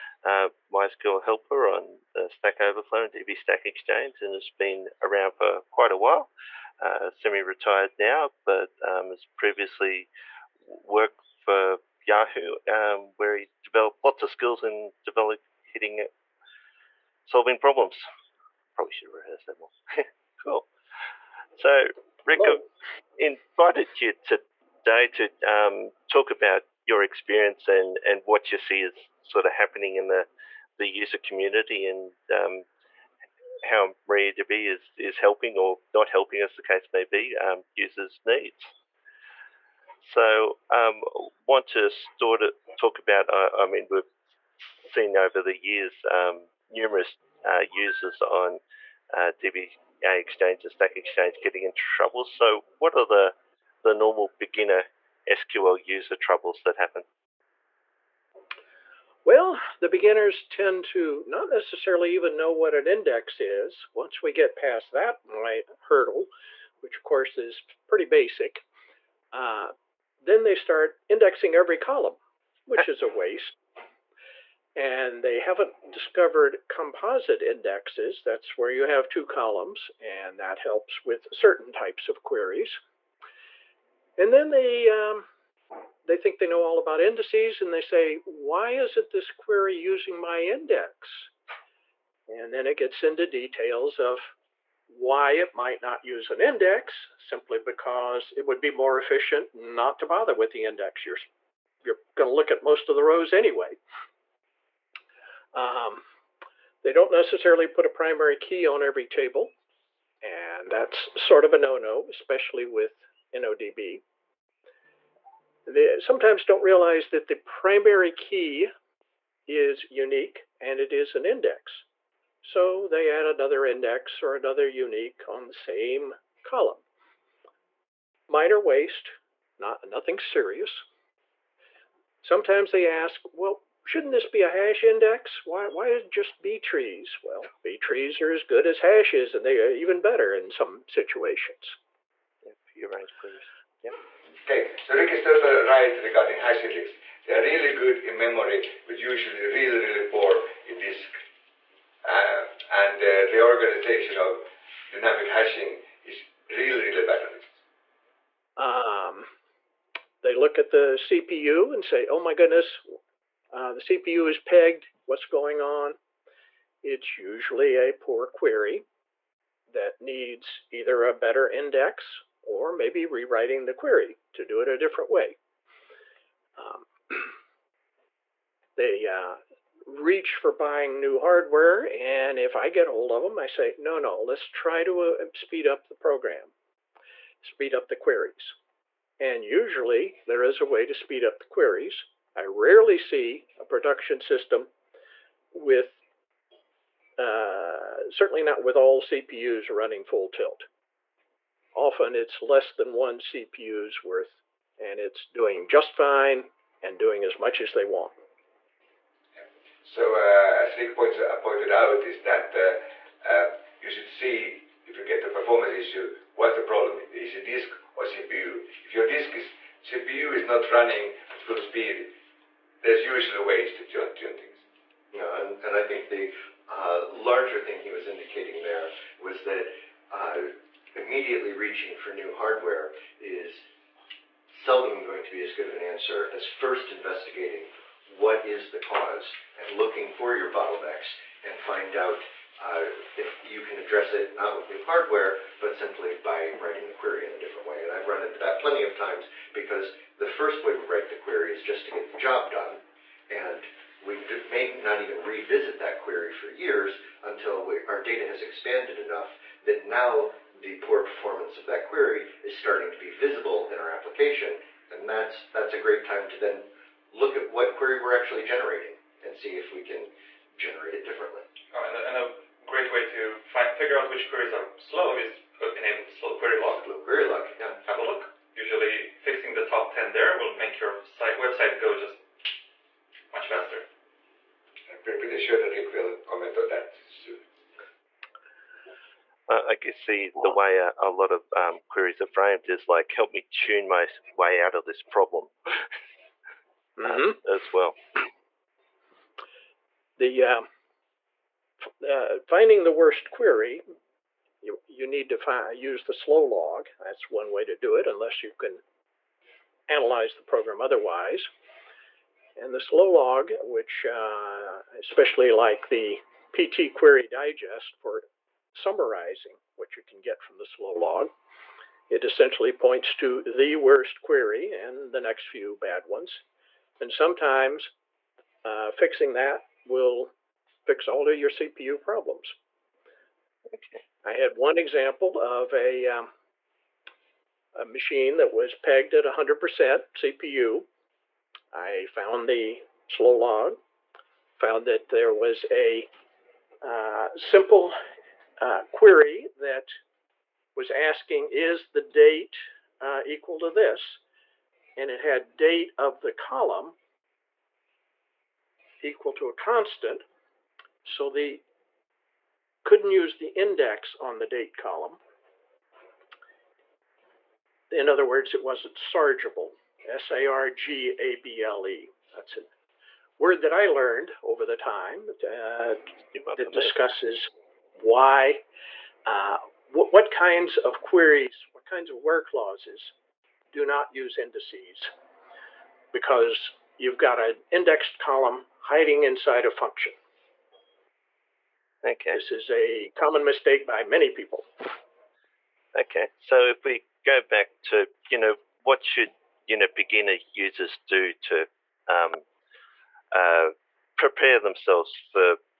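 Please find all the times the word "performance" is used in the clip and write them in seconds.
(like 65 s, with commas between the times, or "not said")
215 s, 261 s.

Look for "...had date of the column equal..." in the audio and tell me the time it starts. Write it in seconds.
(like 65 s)
355 s.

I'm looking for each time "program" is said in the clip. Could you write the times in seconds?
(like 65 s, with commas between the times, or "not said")
185 s, 310 s.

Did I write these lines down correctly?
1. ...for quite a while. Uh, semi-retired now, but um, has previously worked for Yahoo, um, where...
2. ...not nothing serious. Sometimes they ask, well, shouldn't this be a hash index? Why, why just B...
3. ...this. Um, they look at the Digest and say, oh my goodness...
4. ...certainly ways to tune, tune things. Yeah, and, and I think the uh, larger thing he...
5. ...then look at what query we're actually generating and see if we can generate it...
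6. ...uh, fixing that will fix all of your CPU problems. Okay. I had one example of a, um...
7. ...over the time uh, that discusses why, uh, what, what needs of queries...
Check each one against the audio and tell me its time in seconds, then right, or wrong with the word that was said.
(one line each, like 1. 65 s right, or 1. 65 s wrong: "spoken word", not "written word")
1. 5 s right
2. 129 s right
3. 157 s wrong: "CPU", not "Digest"
4. 223 s wrong: "usually", not "certainly"
5. 266 s right
6. 328 s right
7. 374 s wrong: "kinds", not "needs".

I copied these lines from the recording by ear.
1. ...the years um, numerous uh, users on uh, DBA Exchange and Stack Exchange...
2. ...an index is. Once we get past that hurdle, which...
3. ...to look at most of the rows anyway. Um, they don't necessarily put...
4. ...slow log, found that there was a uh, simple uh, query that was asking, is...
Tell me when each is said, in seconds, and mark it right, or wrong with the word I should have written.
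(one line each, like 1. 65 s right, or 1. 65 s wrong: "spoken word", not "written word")
1. 45 s right
2. 62 s right
3. 102 s right
4. 343 s right.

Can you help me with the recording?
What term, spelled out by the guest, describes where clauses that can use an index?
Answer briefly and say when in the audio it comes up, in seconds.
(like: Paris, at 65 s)
Sargeable, at 368 s.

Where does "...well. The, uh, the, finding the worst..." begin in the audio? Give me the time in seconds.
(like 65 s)
297 s.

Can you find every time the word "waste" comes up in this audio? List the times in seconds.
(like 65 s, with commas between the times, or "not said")
73 s, 128 s.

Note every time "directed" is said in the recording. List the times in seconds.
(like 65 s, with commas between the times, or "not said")
not said.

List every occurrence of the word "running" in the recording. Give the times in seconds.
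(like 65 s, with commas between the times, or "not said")
199 s, 220 s.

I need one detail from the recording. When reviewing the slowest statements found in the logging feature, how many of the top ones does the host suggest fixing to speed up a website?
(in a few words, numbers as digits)
10.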